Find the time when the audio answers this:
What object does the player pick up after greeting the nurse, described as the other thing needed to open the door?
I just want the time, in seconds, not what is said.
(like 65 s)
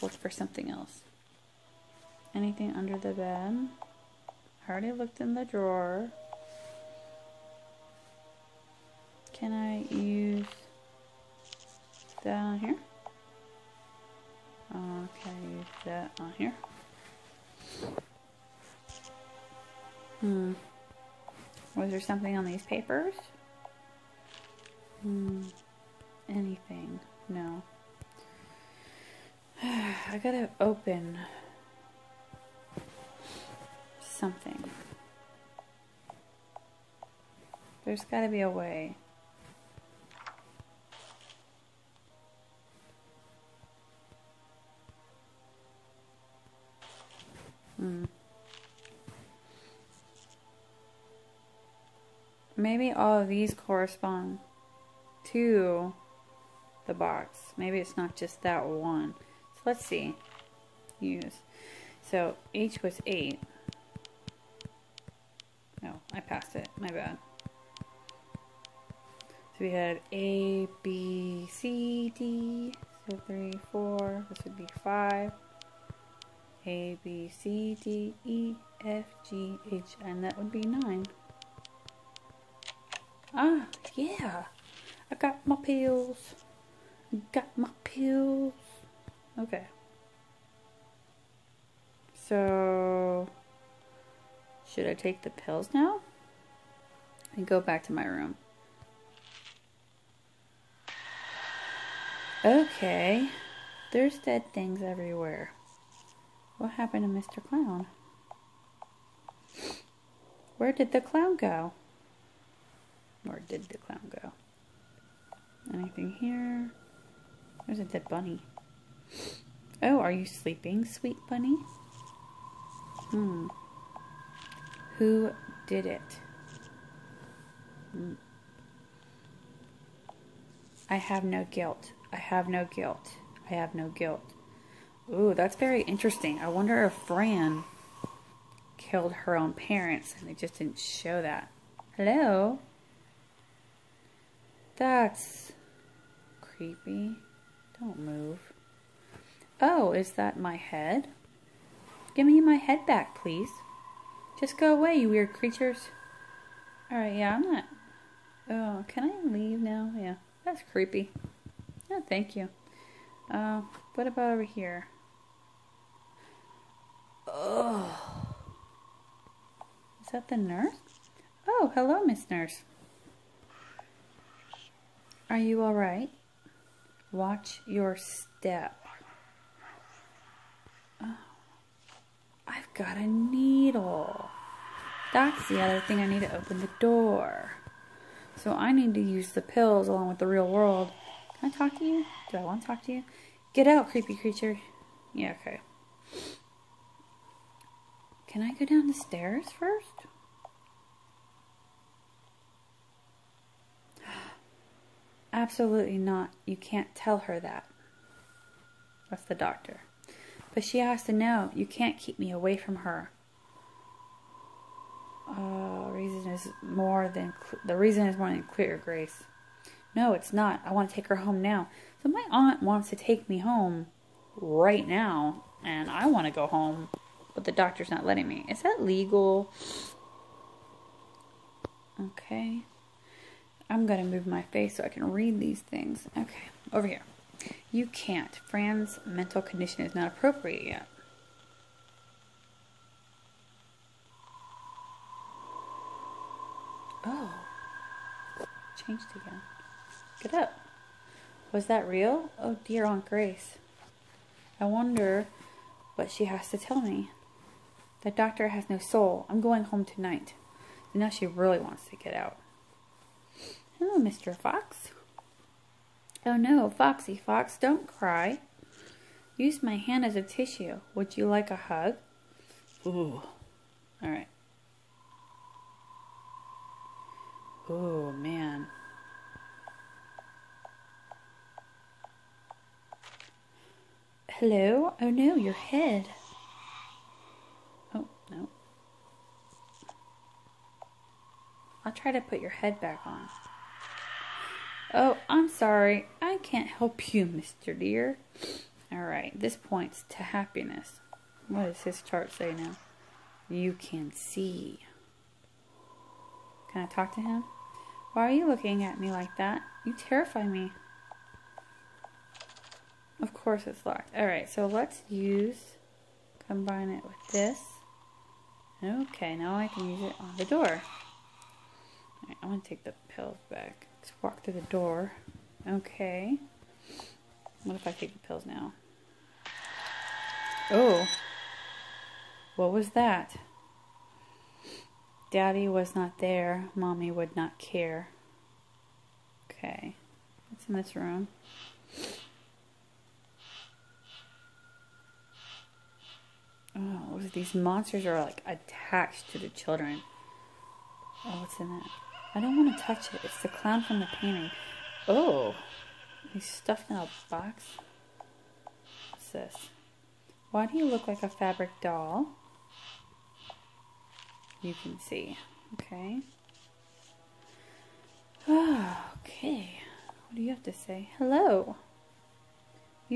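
181 s.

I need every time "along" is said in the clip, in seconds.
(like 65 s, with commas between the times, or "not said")
189 s.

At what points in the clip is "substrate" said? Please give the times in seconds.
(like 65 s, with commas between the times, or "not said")
not said.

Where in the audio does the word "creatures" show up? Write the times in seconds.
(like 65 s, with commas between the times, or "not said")
155 s, 194 s.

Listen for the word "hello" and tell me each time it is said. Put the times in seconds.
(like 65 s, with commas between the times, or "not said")
141 s, 171 s, 263 s, 284 s, 371 s.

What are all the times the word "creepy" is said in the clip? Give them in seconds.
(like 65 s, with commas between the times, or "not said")
146 s, 160 s, 193 s.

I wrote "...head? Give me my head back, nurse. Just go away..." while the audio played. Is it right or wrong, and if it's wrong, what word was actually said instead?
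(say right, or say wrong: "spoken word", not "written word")
wrong: "please", not "nurse".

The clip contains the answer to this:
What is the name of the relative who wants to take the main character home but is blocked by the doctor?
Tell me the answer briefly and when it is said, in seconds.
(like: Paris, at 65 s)
Aunt Grace, at 252 s.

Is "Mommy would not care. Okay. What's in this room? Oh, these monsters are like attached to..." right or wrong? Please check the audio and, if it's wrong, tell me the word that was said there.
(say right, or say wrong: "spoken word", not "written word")
right.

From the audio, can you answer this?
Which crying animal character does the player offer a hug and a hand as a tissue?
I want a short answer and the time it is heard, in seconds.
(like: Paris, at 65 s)
Mr. Fox, at 263 s.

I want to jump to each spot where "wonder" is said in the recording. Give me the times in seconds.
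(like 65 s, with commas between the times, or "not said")
136 s, 254 s.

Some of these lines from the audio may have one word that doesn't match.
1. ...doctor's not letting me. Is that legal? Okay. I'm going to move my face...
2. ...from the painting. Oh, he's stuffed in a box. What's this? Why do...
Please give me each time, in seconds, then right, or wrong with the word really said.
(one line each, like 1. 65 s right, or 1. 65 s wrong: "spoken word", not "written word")
1. 227 s right
2. 353 s right.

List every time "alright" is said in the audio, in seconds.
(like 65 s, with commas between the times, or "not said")
156 s, 175 s, 314 s.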